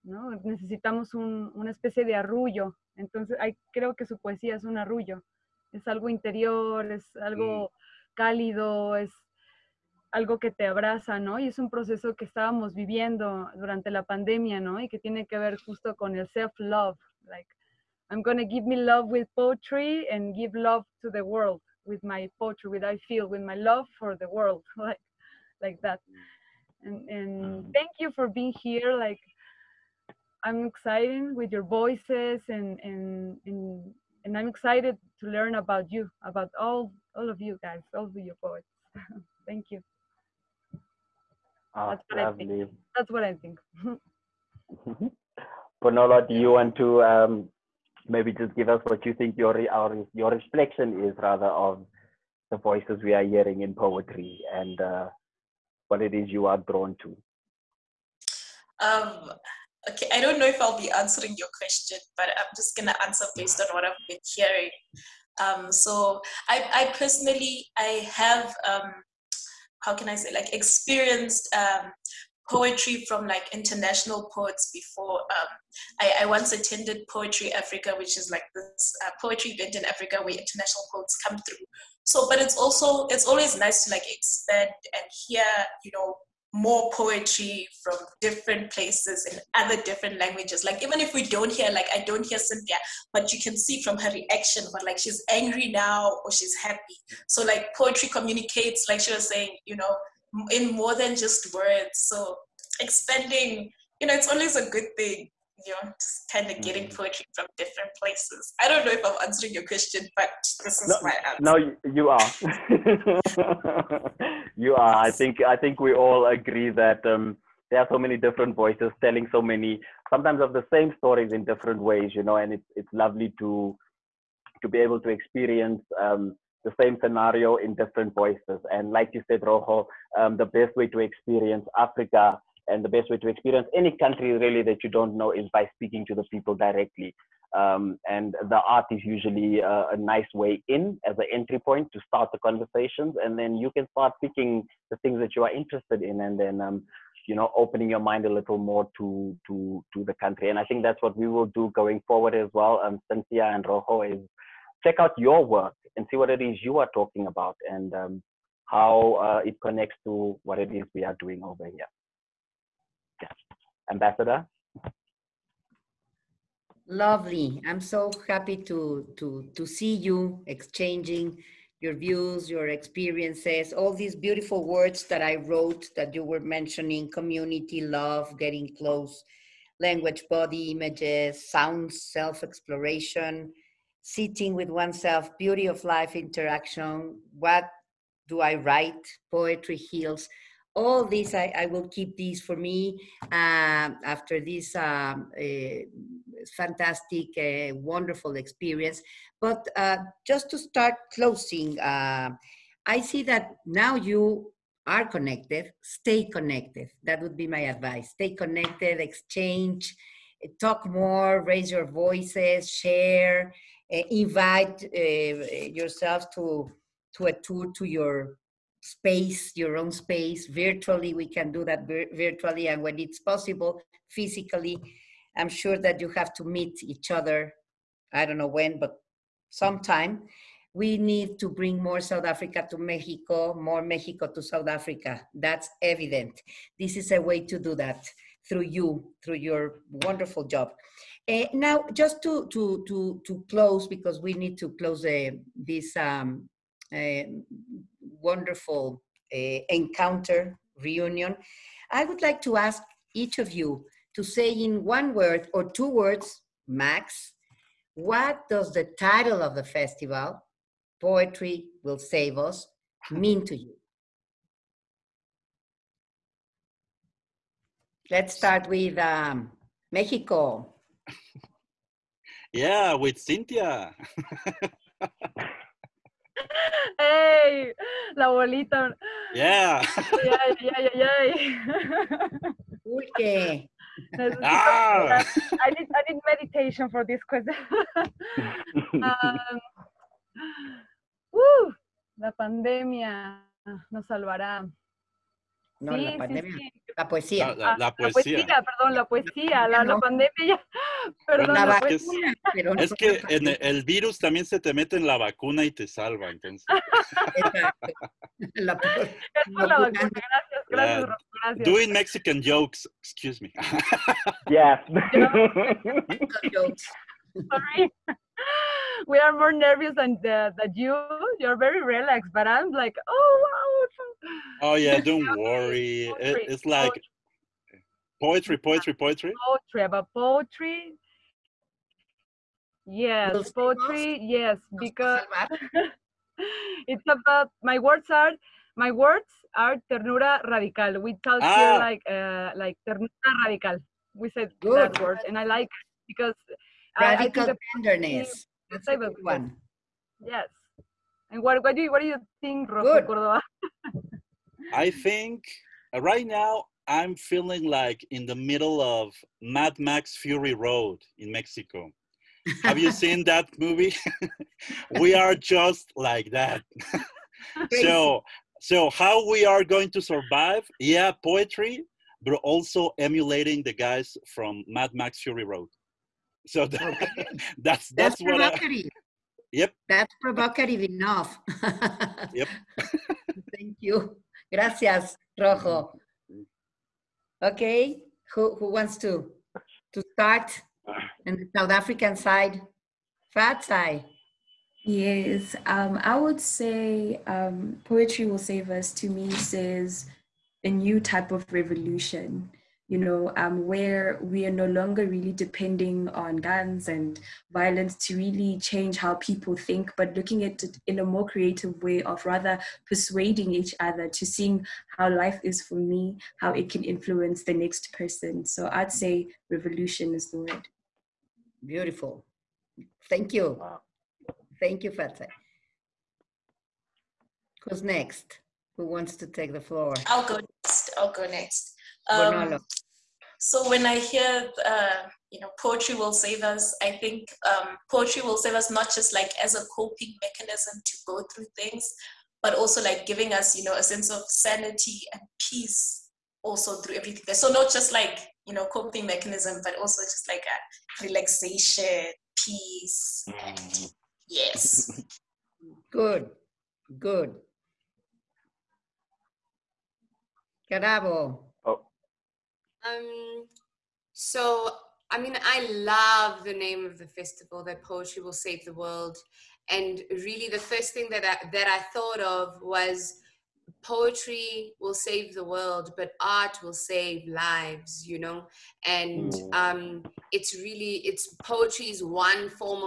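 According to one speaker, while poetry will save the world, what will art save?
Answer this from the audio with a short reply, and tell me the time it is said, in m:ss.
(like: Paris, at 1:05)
lives, at 7:57.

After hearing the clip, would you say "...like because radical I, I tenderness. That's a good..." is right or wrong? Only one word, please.
right.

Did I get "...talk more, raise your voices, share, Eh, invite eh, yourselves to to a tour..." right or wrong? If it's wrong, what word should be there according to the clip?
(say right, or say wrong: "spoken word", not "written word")
right.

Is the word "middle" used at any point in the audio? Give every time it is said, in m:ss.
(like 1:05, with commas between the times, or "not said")
5:58.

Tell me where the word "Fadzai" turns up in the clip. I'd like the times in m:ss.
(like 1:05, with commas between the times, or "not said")
6:33, 7:04.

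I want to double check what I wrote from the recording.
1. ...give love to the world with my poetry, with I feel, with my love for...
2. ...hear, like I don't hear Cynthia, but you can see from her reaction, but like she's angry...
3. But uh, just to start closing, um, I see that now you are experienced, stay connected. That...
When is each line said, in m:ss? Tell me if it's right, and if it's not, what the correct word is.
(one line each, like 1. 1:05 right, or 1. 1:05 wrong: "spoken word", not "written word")
1. 0:20 right
2. 1:31 right
3. 3:19 wrong: "connected", not "experienced".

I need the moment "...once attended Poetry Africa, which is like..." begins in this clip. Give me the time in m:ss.
1:16.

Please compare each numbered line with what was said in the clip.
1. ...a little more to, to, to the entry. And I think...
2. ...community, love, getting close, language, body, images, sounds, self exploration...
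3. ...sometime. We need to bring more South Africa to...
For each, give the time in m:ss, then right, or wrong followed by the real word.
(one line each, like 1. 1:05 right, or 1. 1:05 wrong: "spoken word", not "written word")
1. 2:28 wrong: "country", not "entry"
2. 2:57 right
3. 3:49 right.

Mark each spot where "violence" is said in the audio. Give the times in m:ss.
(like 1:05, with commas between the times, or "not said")
6:47.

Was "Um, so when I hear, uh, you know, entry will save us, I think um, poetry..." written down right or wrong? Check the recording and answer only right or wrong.
wrong.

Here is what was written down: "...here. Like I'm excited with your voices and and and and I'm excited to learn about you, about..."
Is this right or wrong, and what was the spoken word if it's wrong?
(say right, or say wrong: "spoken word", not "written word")
right.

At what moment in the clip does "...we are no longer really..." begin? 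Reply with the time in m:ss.
6:44.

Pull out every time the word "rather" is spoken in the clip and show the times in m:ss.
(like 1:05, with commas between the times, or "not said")
0:51, 6:52.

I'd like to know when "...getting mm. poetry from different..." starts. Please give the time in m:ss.
1:46.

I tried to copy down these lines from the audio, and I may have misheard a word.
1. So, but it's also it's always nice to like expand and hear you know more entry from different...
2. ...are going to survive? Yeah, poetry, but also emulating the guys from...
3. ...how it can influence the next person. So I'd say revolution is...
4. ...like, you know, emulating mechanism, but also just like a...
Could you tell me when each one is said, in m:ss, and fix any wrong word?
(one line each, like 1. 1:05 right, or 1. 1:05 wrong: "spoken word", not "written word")
1. 1:22 wrong: "poetry", not "entry"
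2. 6:09 right
3. 6:56 right
4. 7:27 wrong: "coping", not "emulating".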